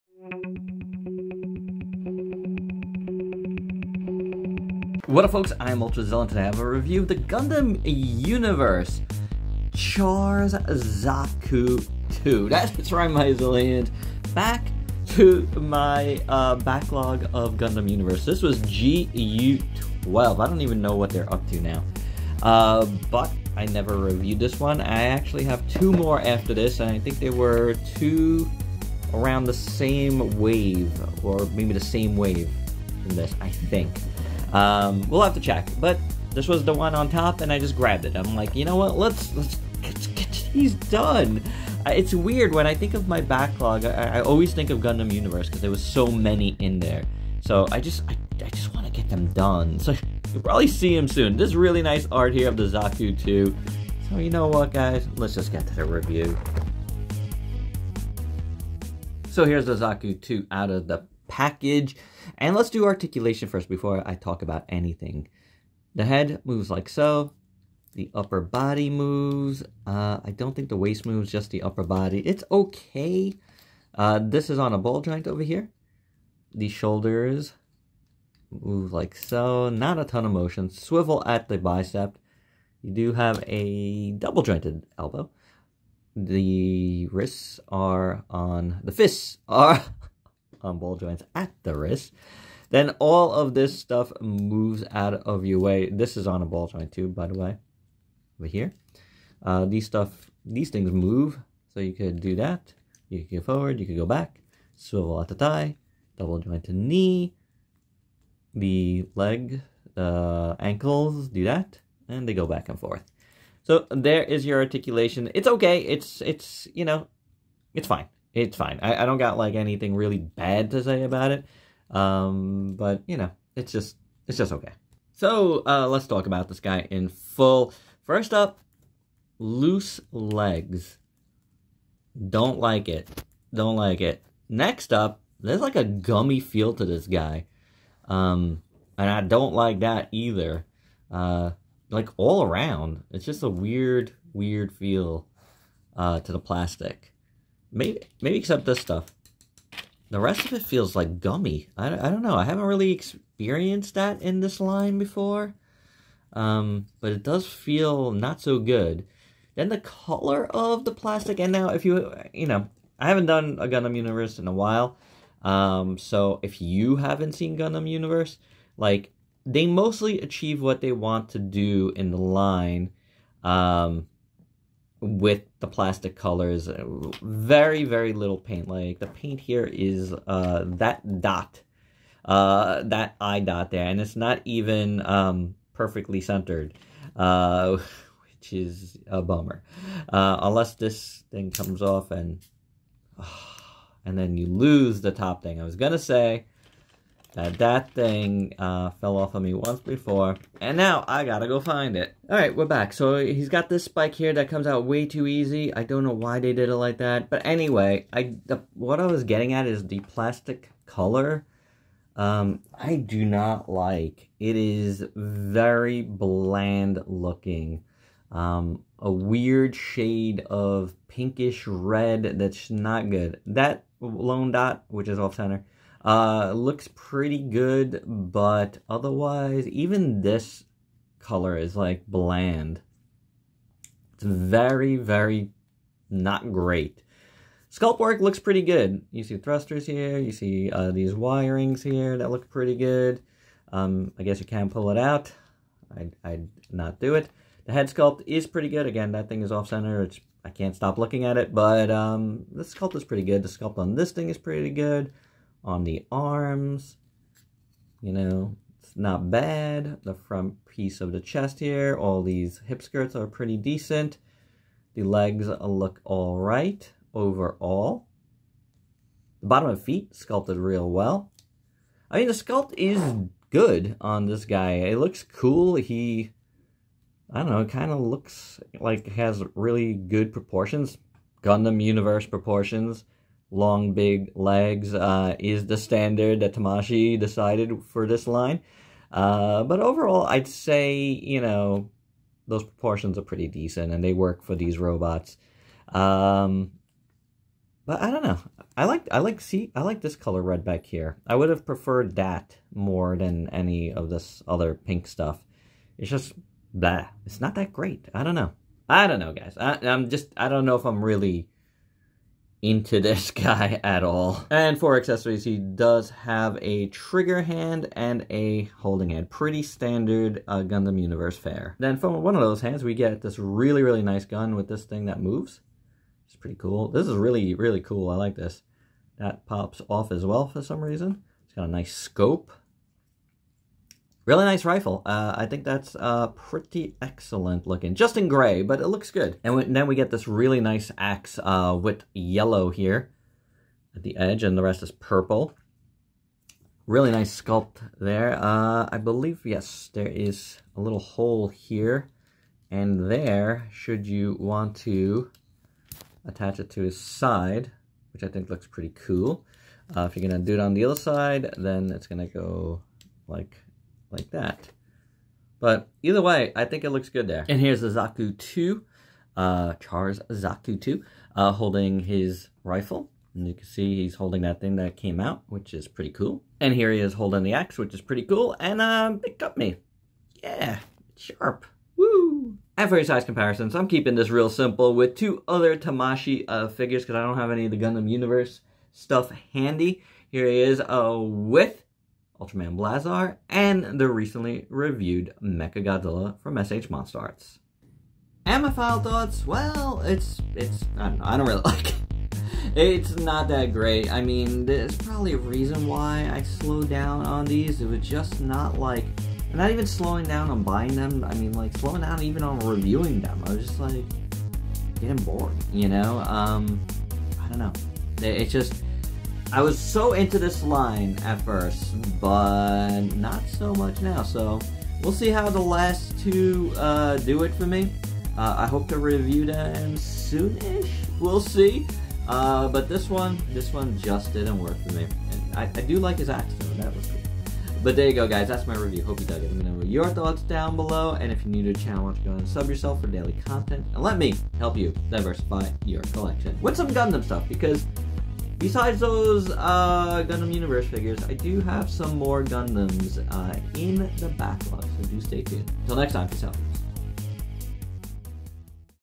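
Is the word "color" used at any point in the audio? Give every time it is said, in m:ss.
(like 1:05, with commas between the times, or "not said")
2:39, 2:56, 3:30, 3:51, 5:00.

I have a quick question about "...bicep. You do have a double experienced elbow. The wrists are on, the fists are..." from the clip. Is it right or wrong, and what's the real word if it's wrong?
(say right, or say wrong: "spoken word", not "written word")
wrong: "jointed", not "experienced".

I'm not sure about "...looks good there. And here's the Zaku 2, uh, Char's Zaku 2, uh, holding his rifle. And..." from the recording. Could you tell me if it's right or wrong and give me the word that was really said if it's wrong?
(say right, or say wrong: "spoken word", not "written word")
right.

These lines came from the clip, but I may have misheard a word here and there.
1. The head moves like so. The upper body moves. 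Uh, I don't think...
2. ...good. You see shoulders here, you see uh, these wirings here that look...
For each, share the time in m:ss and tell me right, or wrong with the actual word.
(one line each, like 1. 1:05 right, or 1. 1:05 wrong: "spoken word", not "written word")
1. 1:05 right
2. 3:58 wrong: "thrusters", not "shoulders".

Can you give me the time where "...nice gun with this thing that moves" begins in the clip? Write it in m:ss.
5:24.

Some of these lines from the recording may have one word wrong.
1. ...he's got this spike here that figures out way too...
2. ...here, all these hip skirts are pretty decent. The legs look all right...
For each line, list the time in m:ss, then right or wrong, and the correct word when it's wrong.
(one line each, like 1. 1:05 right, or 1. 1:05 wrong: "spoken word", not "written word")
1. 3:23 wrong: "comes", not "figures"
2. 4:21 right.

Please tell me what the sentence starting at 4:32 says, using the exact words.
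I mean, the sculpt is good on this guy.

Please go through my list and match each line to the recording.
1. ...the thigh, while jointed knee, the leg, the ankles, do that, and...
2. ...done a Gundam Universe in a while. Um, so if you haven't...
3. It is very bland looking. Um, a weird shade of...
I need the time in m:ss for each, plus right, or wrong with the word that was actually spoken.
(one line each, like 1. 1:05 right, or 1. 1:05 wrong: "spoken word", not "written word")
1. 1:45 wrong: "double", not "while"
2. 2:43 right
3. 3:34 right.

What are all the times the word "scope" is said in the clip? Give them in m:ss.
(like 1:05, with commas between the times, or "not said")
5:31.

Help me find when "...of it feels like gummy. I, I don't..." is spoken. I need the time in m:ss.
2:30.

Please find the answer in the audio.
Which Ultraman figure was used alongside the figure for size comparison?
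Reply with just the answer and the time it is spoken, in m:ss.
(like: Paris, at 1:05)
Ultraman Blazar, at 6:32.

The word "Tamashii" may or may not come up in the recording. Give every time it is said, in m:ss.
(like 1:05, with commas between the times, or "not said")
4:46, 6:25.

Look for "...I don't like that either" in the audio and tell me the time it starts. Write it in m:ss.
2:19.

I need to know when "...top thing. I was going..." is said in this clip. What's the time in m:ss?
3:15.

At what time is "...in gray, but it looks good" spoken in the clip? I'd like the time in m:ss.
5:38.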